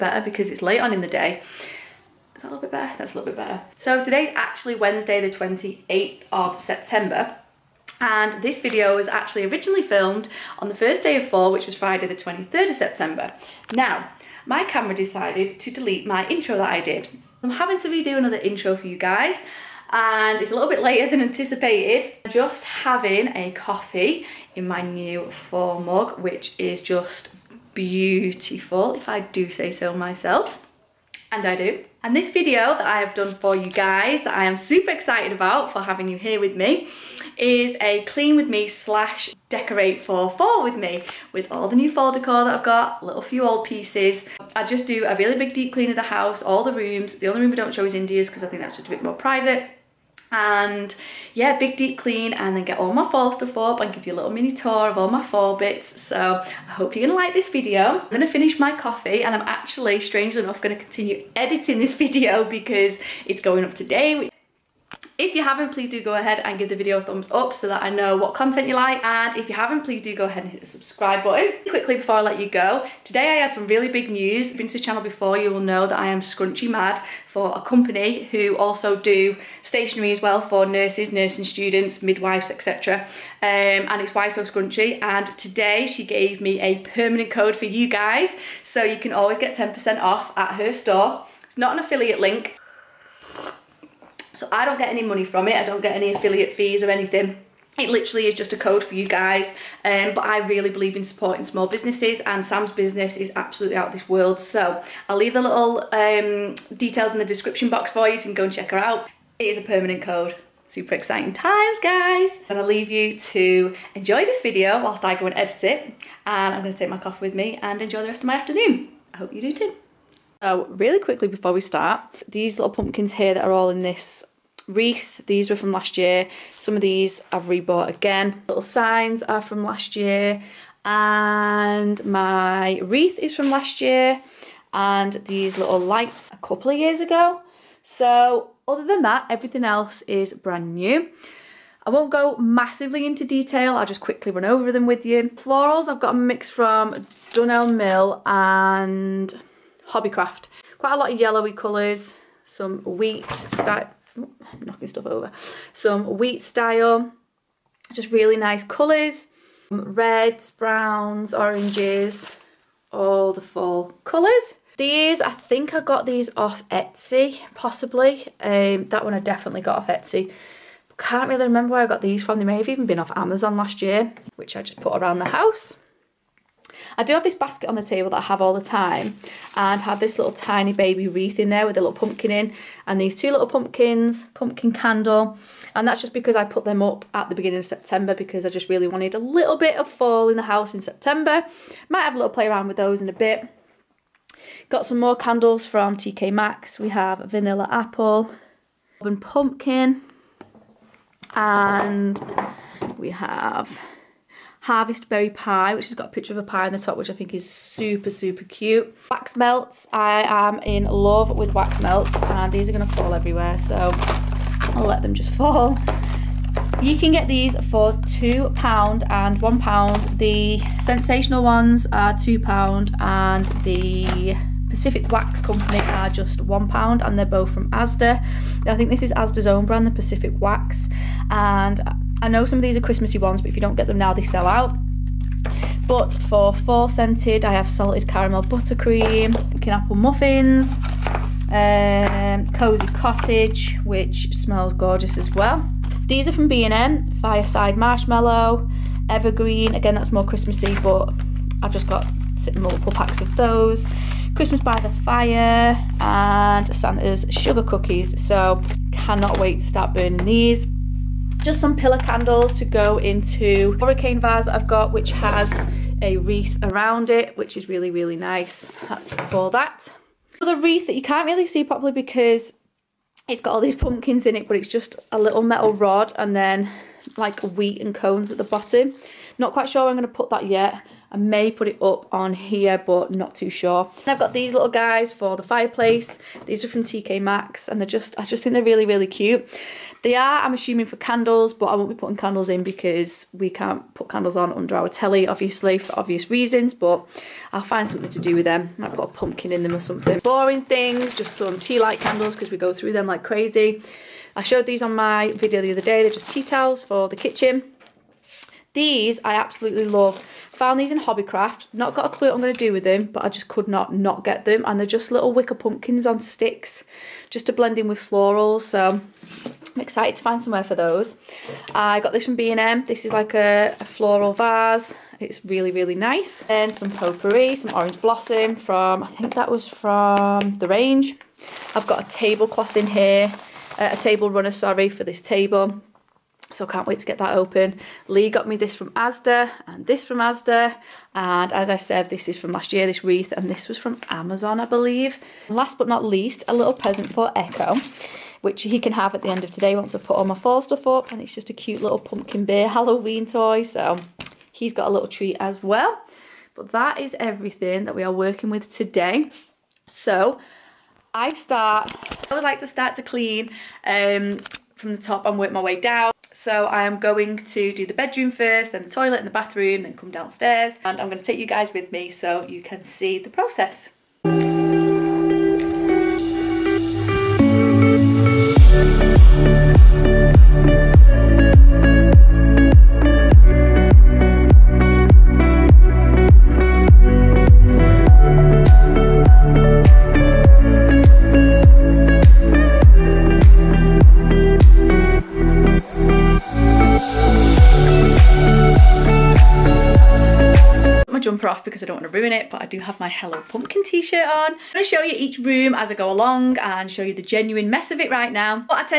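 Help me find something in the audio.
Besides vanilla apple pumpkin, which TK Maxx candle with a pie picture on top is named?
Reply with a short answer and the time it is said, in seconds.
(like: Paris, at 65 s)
Harvest Berry Pie, at 204 s.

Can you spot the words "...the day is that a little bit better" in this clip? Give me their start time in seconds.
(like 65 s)
1 s.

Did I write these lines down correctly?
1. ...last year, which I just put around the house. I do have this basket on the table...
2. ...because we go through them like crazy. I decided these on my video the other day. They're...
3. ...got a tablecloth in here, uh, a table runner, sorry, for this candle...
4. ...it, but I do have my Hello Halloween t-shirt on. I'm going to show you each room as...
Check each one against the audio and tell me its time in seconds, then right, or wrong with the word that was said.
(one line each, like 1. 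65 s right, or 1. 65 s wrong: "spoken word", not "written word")
1. 173 s right
2. 302 s wrong: "showed", not "decided"
3. 331 s wrong: "table", not "candle"
4. 402 s wrong: "Pumpkin", not "Halloween".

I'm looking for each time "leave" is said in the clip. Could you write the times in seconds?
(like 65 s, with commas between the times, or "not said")
105 s, 112 s.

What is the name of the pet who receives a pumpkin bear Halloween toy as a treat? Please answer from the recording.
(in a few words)
Echo.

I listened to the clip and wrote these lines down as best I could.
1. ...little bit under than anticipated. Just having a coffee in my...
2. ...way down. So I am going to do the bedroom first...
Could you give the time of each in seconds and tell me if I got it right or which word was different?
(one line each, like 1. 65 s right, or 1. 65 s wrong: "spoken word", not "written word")
1. 20 s wrong: "later", not "under"
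2. 365 s right.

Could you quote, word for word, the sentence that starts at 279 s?
Not quite sure I'm going to put that yet.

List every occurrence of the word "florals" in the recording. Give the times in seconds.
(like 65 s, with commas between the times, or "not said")
145 s, 317 s, 323 s.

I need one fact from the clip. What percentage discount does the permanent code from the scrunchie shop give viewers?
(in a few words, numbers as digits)
10%.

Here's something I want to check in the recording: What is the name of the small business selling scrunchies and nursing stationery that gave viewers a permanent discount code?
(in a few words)
Why So Scrunchie.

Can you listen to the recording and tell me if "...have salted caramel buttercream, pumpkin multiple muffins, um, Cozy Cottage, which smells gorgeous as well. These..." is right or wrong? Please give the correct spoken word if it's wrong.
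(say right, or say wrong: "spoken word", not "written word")
wrong: "apple", not "multiple".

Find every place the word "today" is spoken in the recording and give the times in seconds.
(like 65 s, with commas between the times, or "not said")
4 s, 63 s, 73 s, 85 s, 349 s, 358 s.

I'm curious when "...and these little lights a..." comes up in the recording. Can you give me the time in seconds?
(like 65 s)
134 s.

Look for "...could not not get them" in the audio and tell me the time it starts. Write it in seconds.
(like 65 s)
313 s.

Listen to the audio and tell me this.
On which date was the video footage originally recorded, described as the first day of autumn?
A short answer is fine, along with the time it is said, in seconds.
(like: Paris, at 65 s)
Friday 23rd September, at 11 s.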